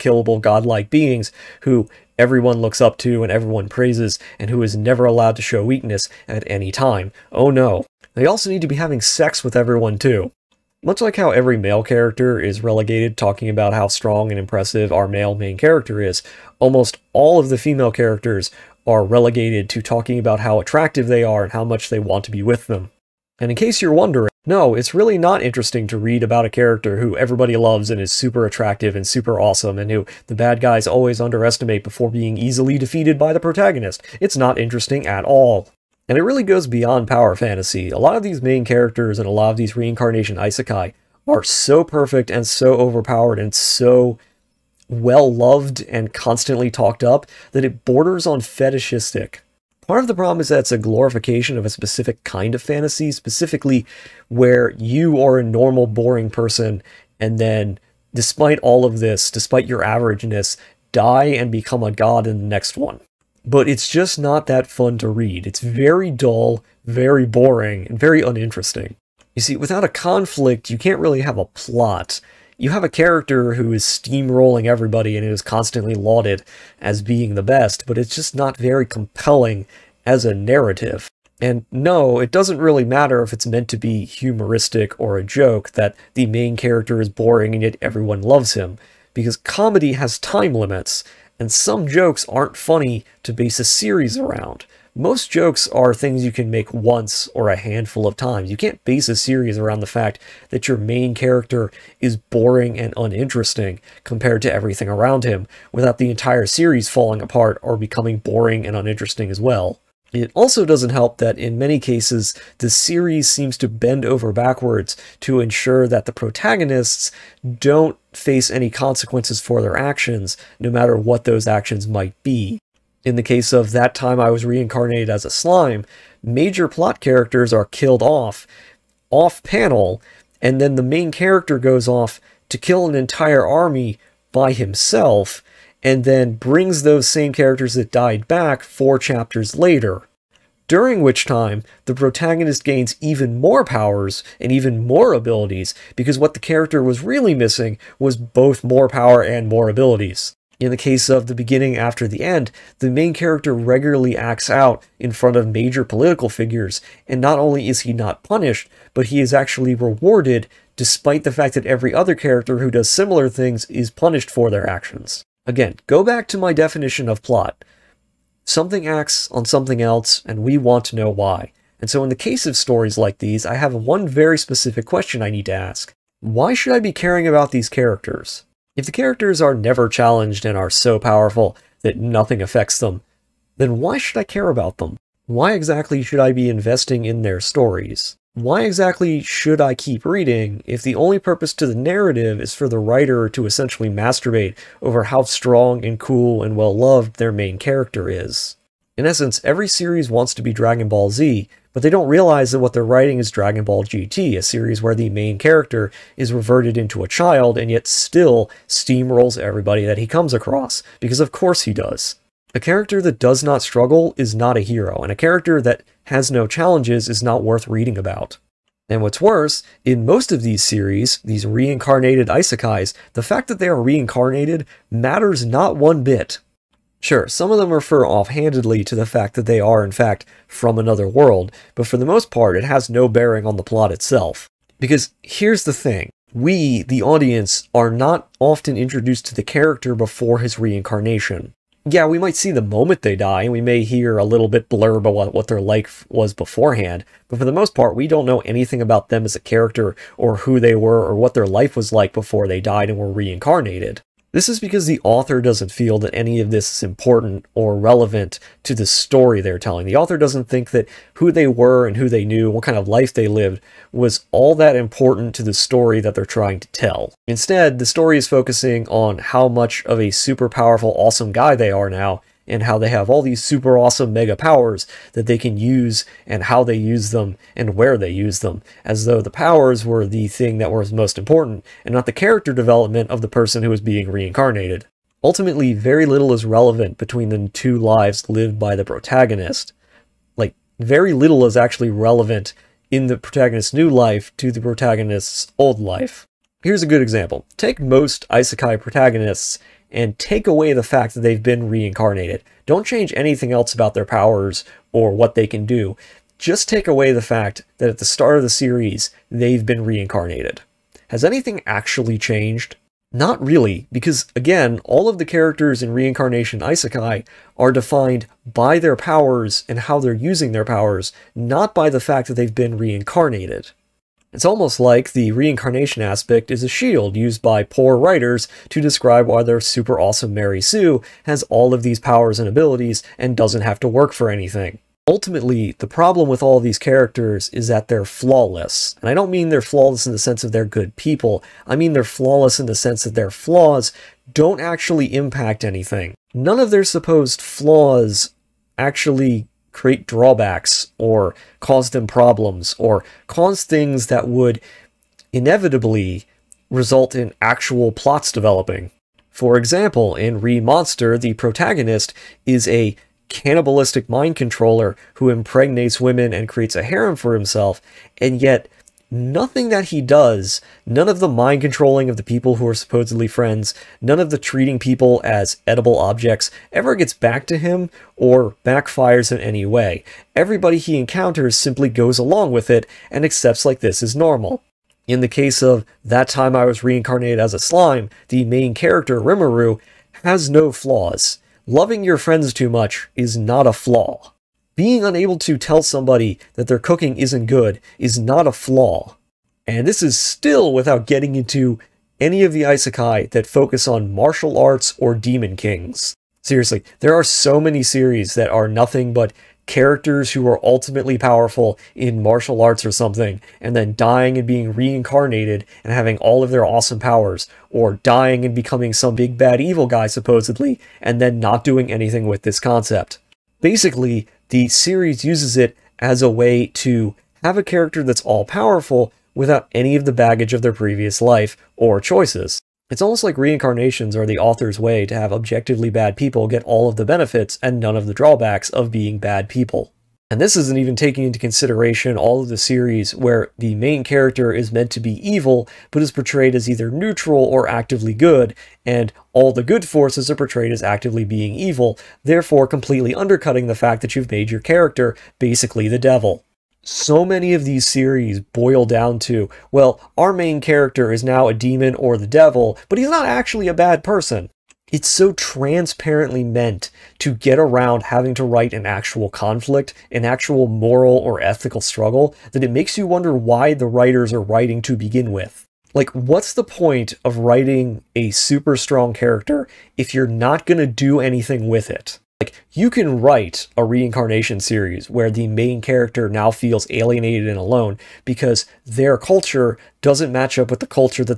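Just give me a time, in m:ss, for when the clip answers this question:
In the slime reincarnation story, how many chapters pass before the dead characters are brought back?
2:18.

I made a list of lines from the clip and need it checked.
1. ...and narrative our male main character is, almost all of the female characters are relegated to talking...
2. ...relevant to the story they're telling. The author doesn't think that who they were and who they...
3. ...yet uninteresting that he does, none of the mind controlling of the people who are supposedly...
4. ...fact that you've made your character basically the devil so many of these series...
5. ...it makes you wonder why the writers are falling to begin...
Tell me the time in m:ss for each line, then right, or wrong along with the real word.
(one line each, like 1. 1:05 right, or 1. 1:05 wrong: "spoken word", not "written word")
1. 0:14 wrong: "impressive", not "narrative"
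2. 4:17 right
3. 6:08 wrong: "nothing", not "uninteresting"
4. 7:33 right
5. 7:52 wrong: "writing", not "falling".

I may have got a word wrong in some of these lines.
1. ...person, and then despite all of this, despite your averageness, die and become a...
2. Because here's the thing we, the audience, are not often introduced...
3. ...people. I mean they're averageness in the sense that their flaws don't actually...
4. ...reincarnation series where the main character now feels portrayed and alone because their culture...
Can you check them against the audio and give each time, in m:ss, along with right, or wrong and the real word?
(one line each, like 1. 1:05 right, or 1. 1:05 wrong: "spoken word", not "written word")
1. 0:56 right
2. 3:54 right
3. 5:40 wrong: "flawless", not "averageness"
4. 8:03 wrong: "alienated", not "portrayed".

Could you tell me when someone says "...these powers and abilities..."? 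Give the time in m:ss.
5:31.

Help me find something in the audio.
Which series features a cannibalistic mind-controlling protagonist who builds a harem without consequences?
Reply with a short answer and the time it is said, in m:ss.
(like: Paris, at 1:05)
Re Monster, at 6:00.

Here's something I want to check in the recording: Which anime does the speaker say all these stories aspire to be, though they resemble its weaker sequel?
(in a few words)
Dragon Ball Z.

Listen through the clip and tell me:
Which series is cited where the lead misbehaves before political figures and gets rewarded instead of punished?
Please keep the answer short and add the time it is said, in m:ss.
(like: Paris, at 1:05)
The Beginning After the End, at 2:31.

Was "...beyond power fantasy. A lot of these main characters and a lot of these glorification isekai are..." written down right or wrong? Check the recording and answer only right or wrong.
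wrong.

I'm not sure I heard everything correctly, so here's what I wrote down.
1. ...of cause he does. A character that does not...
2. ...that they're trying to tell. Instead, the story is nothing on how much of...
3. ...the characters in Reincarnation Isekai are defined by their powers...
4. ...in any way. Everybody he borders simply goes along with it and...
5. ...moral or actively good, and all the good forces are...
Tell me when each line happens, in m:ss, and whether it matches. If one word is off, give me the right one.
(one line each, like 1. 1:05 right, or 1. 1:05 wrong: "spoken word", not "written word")
1. 3:31 wrong: "course", not "cause"
2. 4:26 wrong: "focusing", not "nothing"
3. 5:15 right
4. 6:19 wrong: "encounters", not "borders"
5. 7:26 wrong: "neutral", not "moral".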